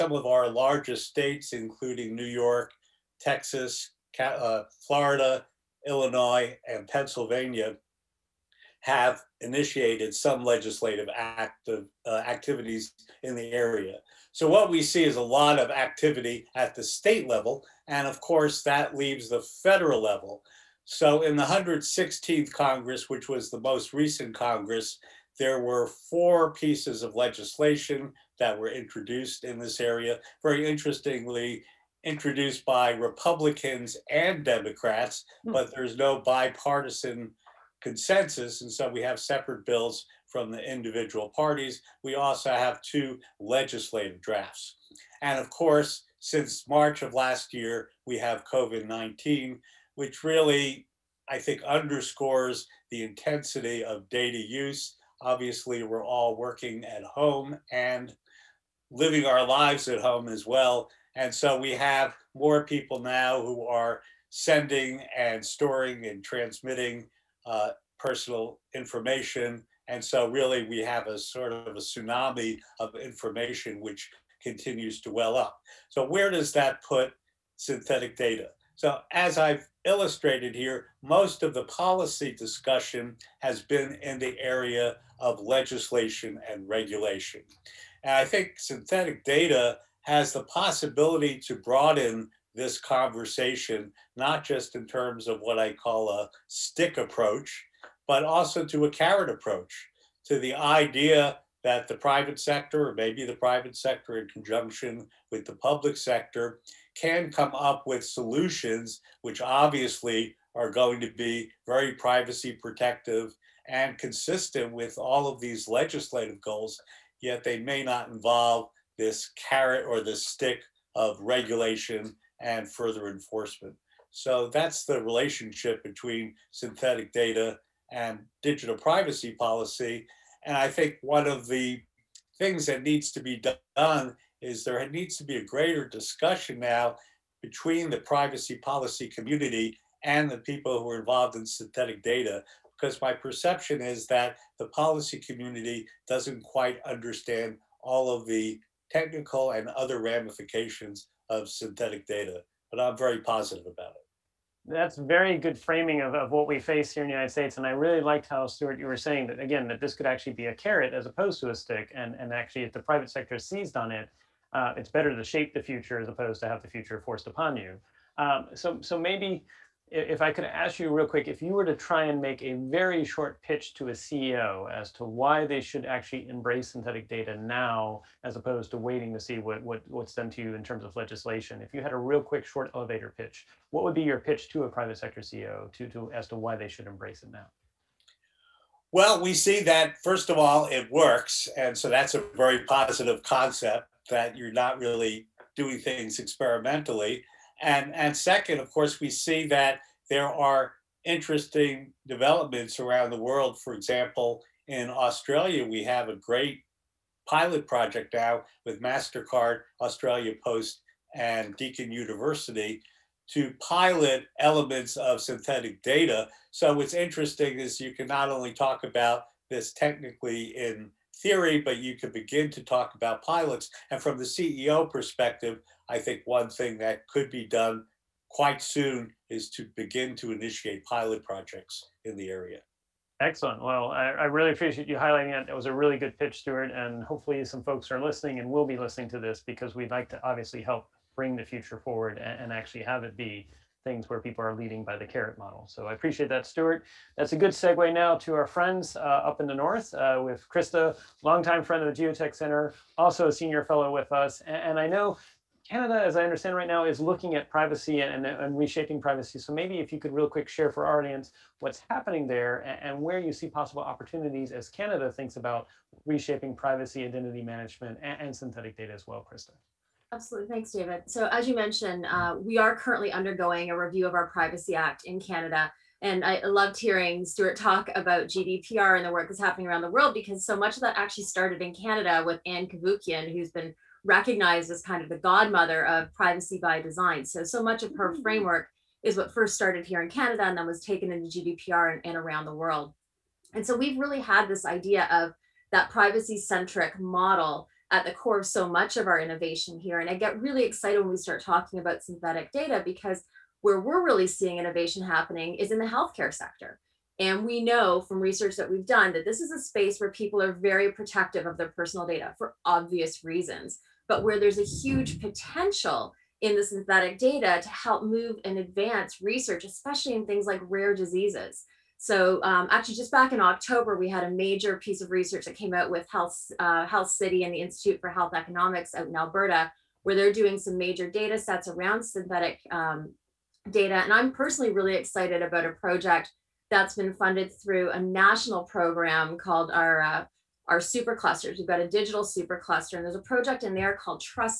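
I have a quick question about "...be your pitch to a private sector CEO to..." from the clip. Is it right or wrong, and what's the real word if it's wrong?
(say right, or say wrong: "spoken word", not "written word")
right.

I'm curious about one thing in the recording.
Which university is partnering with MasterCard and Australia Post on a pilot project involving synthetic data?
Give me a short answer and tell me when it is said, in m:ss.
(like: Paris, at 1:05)
Deakin University, at 3:31.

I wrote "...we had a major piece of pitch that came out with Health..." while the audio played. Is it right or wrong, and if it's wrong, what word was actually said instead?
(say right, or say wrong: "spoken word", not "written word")
wrong: "research", not "pitch".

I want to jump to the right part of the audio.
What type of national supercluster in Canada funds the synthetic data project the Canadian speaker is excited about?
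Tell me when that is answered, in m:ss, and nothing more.
5:41.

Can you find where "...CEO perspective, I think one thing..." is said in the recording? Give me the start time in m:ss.
3:44.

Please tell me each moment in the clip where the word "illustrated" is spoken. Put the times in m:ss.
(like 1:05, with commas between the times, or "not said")
1:19.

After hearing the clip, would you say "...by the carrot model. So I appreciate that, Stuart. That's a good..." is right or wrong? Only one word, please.
right.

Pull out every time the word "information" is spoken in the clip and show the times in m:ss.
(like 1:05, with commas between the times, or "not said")
1:08, 1:12.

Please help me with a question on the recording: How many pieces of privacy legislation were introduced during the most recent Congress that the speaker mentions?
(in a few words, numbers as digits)
4.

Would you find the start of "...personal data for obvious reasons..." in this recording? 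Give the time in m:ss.
5:11.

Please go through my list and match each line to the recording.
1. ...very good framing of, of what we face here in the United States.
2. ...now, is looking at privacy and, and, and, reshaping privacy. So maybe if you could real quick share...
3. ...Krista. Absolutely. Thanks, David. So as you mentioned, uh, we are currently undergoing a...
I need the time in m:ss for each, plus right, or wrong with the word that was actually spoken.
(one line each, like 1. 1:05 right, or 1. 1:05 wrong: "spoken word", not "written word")
1. 2:34 right
2. 4:16 right
3. 4:29 right.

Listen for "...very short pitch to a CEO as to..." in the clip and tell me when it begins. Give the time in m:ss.
2:52.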